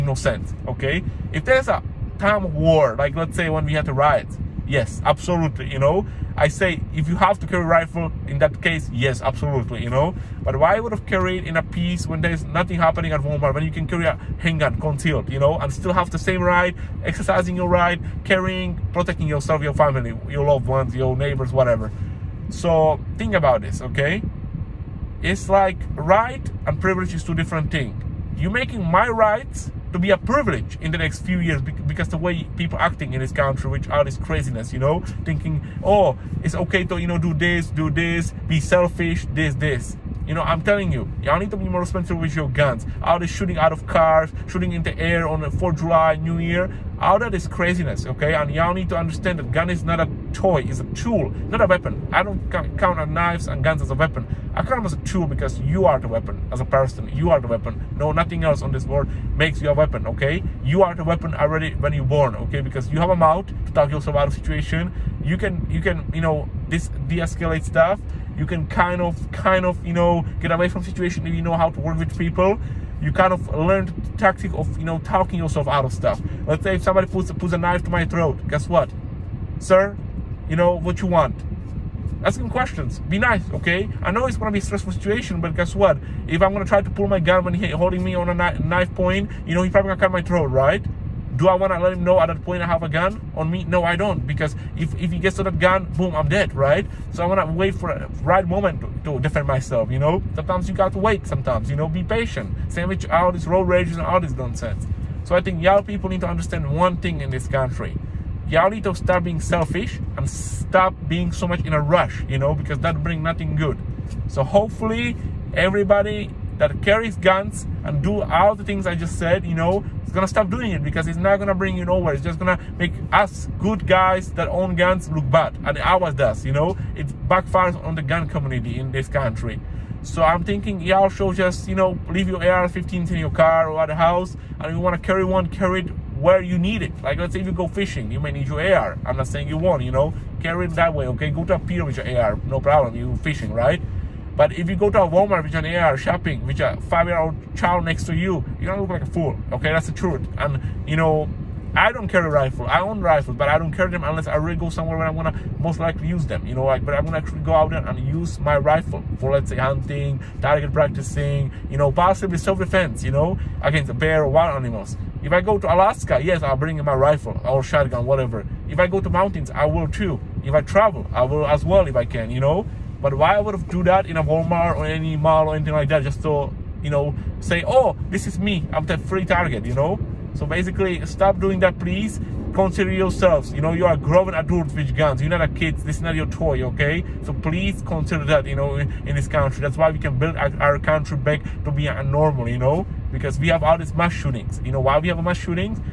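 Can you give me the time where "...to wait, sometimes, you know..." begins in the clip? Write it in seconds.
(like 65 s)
100 s.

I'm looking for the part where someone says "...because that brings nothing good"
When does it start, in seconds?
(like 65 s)
112 s.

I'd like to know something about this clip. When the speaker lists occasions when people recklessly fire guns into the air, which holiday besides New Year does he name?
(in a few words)
4th of July.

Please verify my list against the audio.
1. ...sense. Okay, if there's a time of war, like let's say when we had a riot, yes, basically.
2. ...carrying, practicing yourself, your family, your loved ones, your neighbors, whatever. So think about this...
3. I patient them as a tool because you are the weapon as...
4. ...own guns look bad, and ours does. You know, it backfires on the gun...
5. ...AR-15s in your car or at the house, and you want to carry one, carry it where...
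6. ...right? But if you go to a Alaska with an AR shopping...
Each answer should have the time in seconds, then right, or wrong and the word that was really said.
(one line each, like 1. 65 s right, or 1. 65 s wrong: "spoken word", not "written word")
1. 0 s wrong: "absolutely", not "basically"
2. 18 s wrong: "protecting", not "practicing"
3. 54 s wrong: "count", not "patient"
4. 124 s right
5. 132 s right
6. 143 s wrong: "Walmart", not "Alaska".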